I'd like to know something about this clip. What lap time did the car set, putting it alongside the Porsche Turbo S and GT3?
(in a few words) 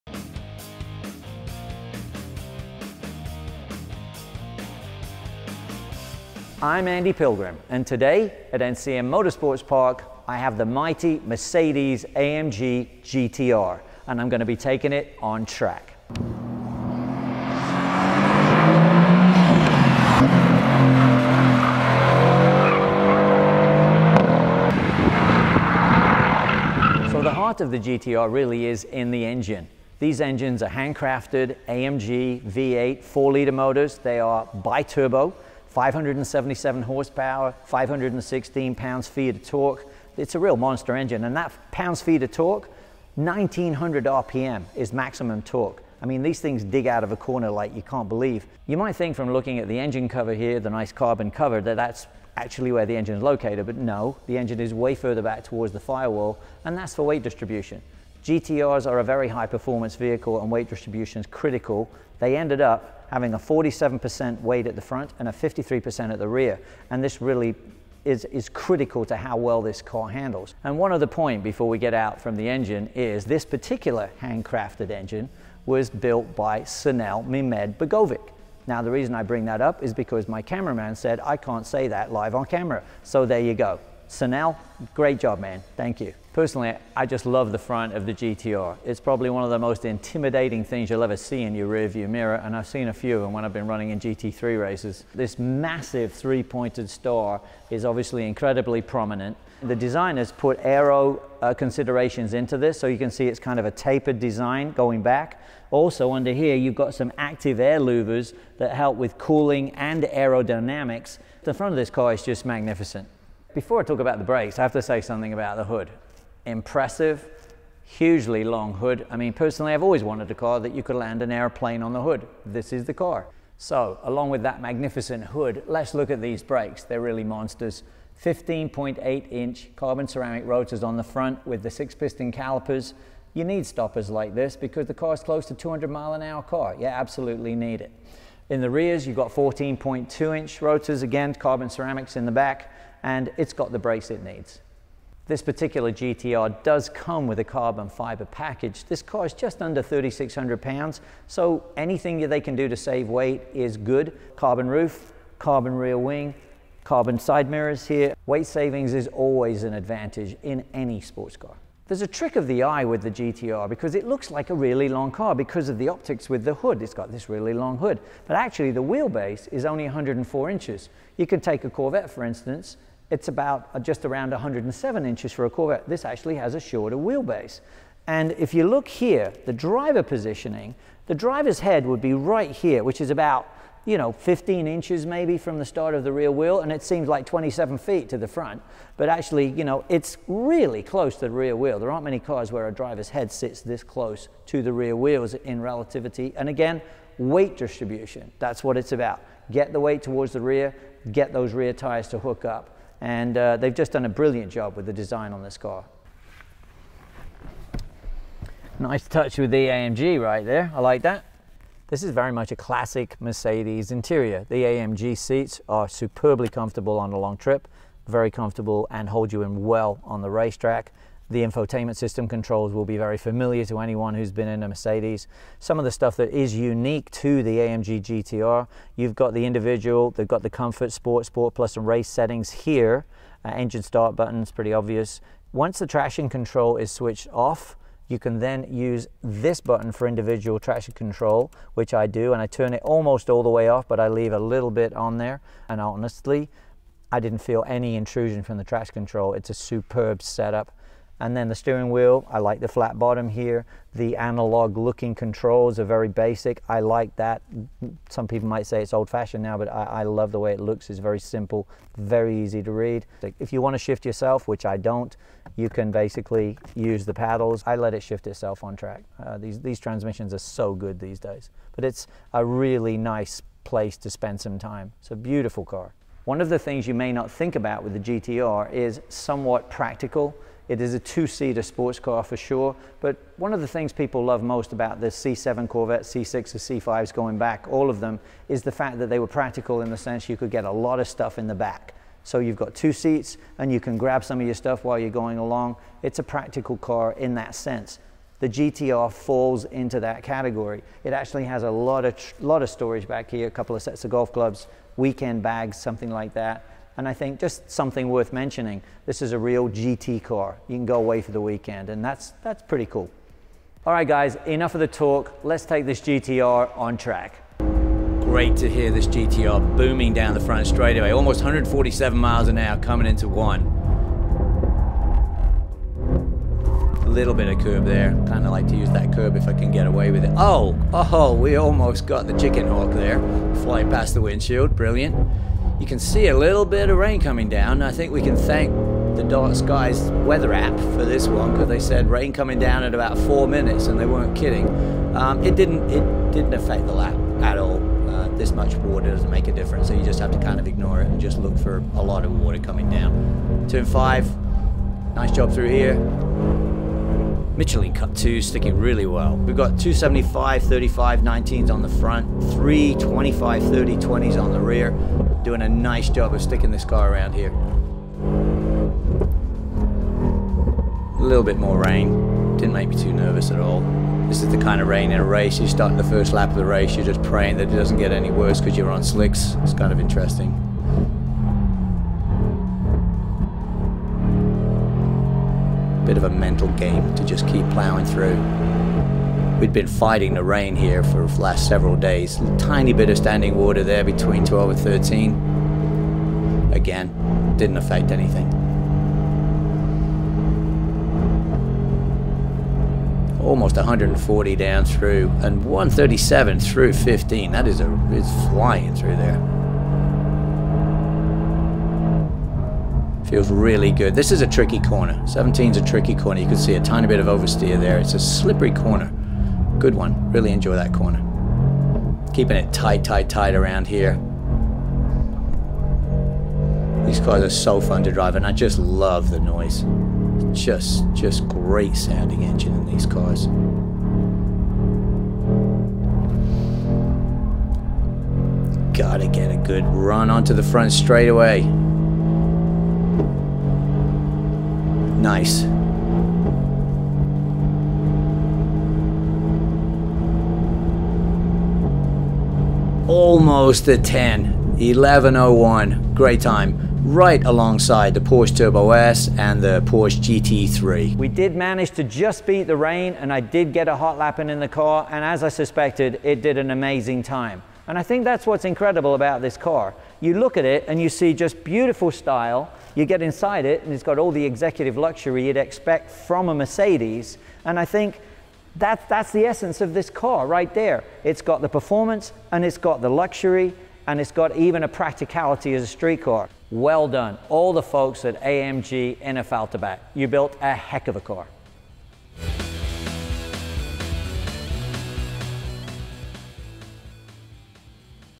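1:10.1.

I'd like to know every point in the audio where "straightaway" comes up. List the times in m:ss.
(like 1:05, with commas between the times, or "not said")
5:20, 7:20.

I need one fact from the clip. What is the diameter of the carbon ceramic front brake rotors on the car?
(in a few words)
15.8 inches.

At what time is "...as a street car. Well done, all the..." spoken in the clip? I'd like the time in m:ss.
8:05.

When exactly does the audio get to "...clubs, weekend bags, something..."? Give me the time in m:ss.
5:04.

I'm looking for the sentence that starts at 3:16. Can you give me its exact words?
And again, weight distribution, that's what it's about.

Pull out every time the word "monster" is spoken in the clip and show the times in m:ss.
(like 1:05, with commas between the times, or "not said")
0:40, 2:07.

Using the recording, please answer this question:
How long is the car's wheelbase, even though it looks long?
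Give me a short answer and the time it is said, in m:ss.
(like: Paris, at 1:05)
104 inches, at 2:49.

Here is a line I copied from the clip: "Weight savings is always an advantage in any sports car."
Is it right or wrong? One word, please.
right.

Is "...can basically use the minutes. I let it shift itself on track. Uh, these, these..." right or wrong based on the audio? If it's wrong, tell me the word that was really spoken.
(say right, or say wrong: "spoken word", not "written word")
wrong: "paddles", not "minutes".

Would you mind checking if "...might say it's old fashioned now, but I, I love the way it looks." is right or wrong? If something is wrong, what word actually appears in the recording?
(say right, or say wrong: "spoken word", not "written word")
right.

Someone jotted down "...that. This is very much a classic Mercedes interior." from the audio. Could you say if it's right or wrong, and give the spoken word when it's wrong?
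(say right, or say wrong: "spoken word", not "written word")
right.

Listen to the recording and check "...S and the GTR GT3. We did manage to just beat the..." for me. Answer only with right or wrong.
wrong.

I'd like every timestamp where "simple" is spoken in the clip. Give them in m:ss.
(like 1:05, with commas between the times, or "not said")
4:21.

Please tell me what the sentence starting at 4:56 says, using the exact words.
It's a practical car in that sense.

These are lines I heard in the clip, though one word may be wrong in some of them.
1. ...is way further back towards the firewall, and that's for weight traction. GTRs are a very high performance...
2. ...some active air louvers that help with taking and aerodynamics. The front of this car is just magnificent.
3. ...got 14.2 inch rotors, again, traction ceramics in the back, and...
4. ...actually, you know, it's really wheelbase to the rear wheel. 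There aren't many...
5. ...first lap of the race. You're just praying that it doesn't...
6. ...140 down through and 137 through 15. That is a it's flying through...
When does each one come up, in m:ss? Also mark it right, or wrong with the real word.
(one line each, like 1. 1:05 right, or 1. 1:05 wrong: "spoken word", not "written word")
1. 0:54 wrong: "distribution", not "traction"
2. 1:46 wrong: "cooling", not "taking"
3. 2:19 wrong: "carbon", not "traction"
4. 3:09 wrong: "close", not "wheelbase"
5. 6:16 right
6. 6:43 right.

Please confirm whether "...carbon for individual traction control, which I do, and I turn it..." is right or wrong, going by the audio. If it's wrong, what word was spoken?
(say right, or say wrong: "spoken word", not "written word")
wrong: "button", not "carbon".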